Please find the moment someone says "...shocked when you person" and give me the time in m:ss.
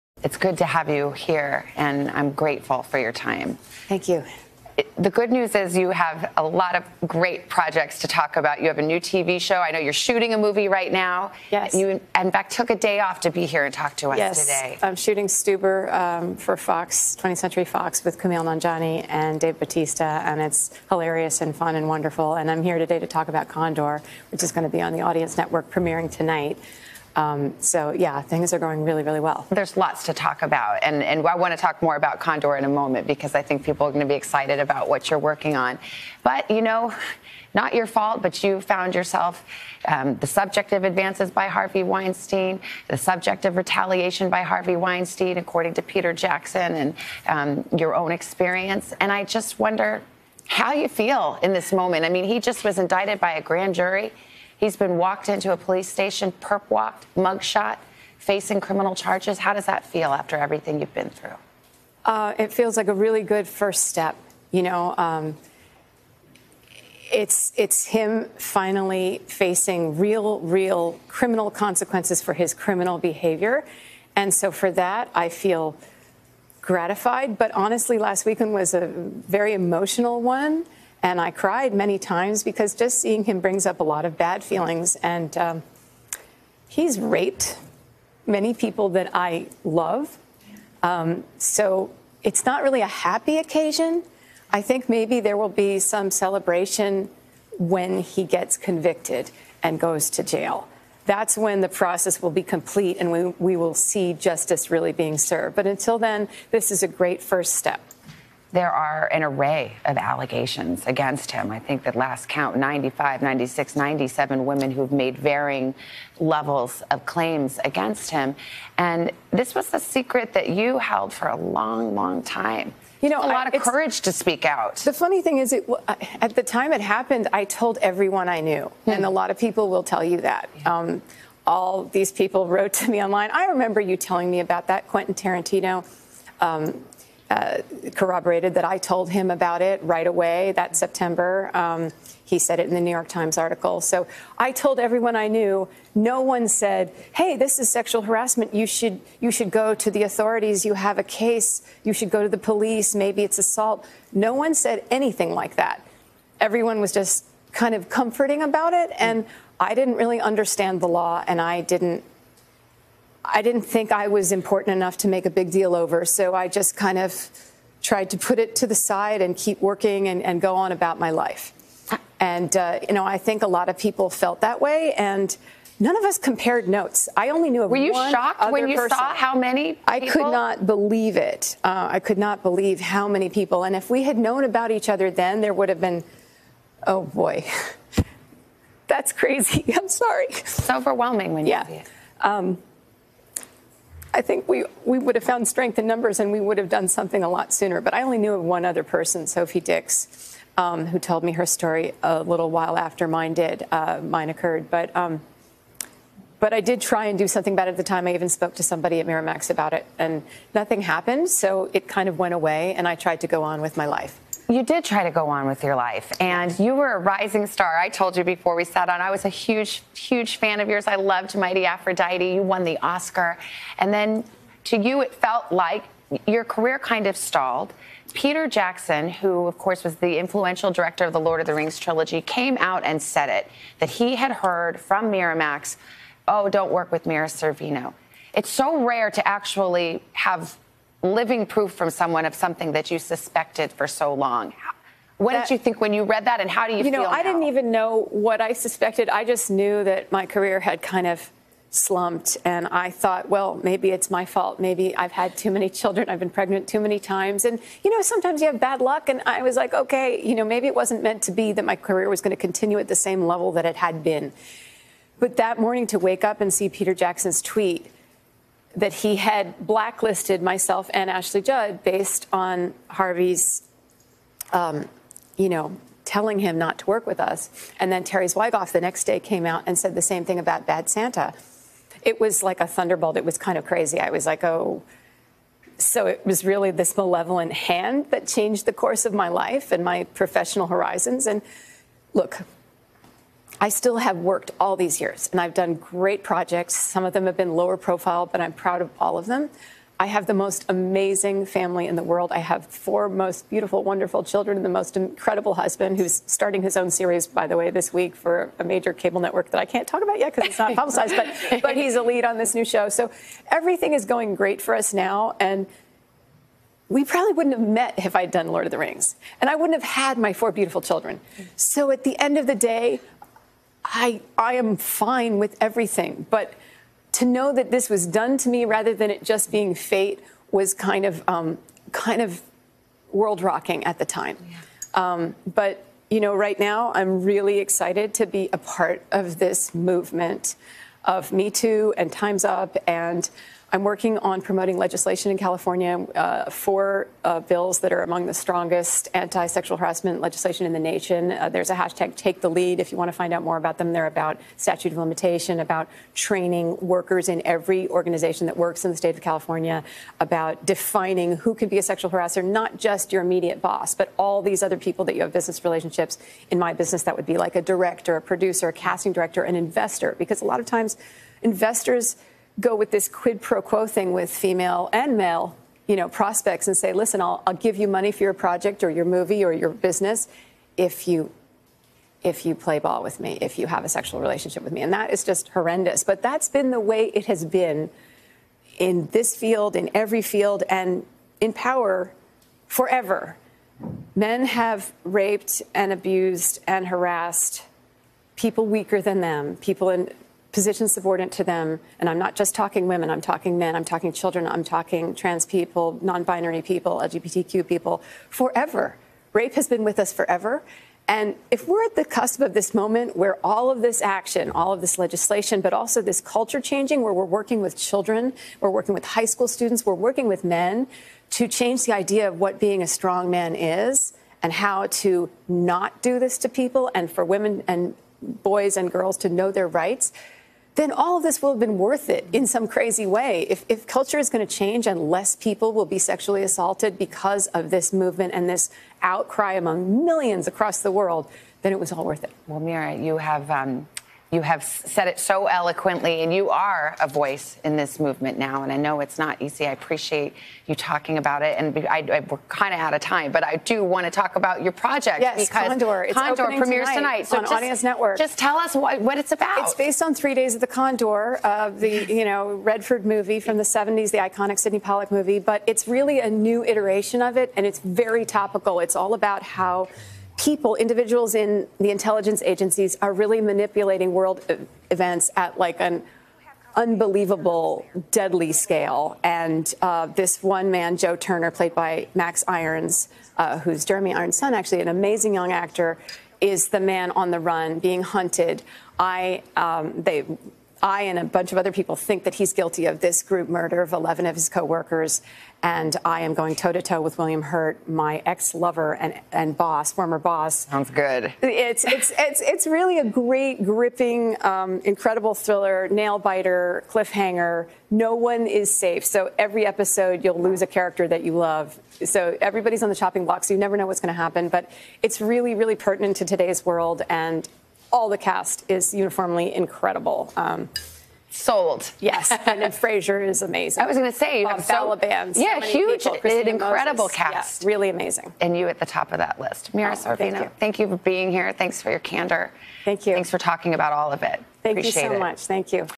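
2:58.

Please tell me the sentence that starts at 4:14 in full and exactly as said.
Maybe I've had too many children.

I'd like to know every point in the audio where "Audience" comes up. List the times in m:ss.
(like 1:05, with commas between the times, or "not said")
0:25, 7:37.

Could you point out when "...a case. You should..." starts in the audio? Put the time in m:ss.
2:30.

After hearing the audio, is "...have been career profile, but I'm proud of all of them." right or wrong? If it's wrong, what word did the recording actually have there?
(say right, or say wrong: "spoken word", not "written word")
wrong: "lower", not "career".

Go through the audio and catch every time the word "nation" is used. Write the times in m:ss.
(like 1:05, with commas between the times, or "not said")
5:50.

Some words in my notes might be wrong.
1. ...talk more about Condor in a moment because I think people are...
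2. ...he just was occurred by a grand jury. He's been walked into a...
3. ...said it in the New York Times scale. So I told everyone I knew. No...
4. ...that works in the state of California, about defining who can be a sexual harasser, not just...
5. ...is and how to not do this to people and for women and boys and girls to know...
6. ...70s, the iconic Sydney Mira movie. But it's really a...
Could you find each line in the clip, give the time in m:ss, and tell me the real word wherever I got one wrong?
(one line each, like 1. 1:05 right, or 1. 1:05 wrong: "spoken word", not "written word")
1. 0:31 right
2. 0:52 wrong: "indicted", not "occurred"
3. 2:22 wrong: "article", not "scale"
4. 5:58 right
5. 7:03 right
6. 7:43 wrong: "Pollack", not "Mira".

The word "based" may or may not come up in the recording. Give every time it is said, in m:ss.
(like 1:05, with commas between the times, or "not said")
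4:31, 7:39.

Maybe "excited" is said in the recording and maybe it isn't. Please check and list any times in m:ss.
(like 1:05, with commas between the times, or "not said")
0:34, 5:37.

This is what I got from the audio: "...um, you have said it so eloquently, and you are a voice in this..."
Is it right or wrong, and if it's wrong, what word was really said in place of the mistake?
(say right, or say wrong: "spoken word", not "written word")
right.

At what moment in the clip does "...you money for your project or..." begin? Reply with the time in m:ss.
6:17.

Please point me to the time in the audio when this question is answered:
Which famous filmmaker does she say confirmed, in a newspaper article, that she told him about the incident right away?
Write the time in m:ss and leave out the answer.
2:14.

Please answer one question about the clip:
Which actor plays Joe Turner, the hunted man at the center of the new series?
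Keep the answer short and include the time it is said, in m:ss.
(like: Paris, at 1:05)
Max Irons, at 8:02.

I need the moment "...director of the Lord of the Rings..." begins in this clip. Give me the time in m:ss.
3:50.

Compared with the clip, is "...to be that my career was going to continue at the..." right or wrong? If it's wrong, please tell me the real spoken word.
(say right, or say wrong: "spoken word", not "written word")
right.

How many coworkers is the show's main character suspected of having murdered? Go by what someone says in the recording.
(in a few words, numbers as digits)
11.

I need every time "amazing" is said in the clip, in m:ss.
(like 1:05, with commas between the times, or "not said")
5:00, 8:04, 8:43, 8:47.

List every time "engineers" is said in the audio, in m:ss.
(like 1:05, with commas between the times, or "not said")
not said.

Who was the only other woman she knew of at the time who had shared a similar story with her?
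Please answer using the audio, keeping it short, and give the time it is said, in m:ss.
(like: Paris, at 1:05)
Sophie Dix, at 3:19.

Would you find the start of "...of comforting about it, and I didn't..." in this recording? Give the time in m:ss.
2:37.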